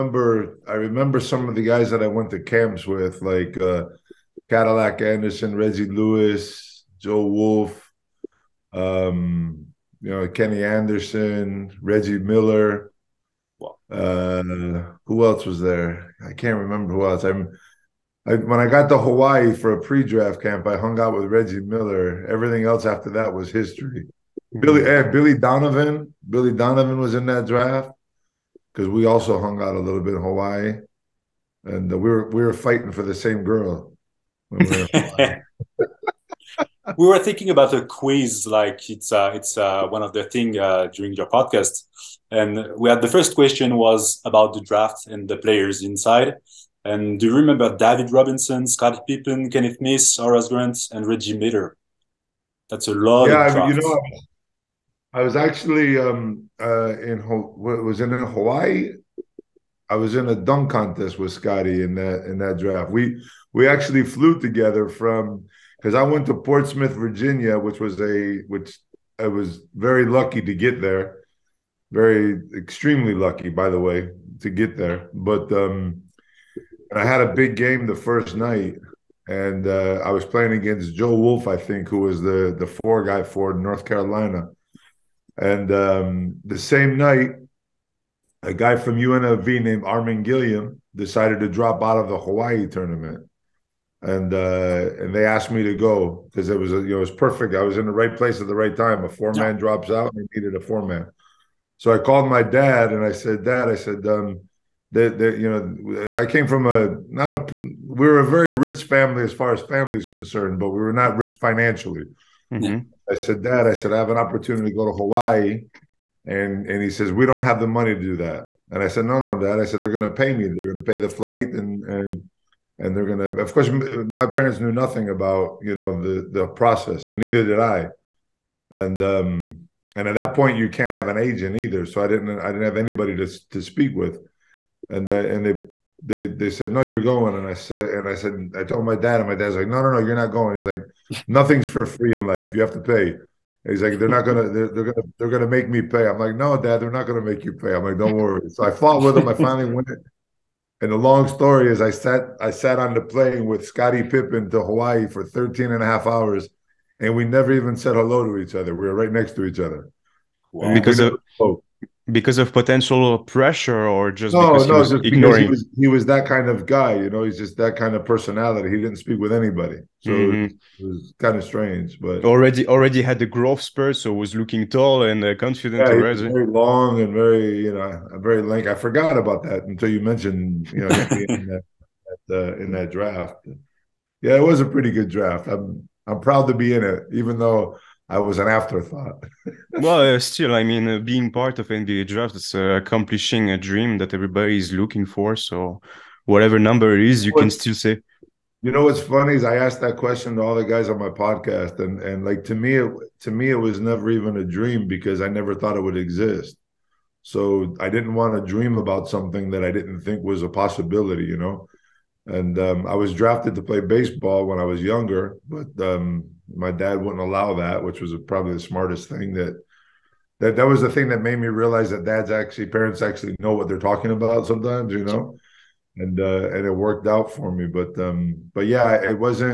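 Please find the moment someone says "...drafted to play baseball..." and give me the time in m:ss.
3:33.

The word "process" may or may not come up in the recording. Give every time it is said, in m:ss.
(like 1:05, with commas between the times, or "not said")
2:06.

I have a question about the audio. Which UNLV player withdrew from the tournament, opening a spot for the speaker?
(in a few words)
Armon Gilliam.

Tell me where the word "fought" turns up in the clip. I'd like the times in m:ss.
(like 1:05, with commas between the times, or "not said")
2:28.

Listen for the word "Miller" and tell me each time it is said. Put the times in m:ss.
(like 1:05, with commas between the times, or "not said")
0:12, 0:21, 0:51.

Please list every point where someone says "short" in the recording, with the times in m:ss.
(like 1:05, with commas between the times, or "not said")
not said.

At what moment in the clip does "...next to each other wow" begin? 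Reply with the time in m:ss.
2:39.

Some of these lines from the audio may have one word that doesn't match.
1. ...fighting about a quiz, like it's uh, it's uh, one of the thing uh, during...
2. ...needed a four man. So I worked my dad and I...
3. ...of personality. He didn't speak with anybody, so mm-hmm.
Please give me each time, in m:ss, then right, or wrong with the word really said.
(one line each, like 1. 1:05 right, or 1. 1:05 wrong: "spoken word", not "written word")
1. 0:37 wrong: "thinking", not "fighting"
2. 1:40 wrong: "called", not "worked"
3. 2:47 right.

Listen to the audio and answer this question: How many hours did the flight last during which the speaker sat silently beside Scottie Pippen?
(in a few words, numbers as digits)
13.5.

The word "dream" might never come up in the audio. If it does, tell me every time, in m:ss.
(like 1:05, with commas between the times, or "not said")
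3:13, 3:24, 3:28.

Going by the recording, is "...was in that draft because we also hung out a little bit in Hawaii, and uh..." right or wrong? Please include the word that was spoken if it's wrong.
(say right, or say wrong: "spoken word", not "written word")
right.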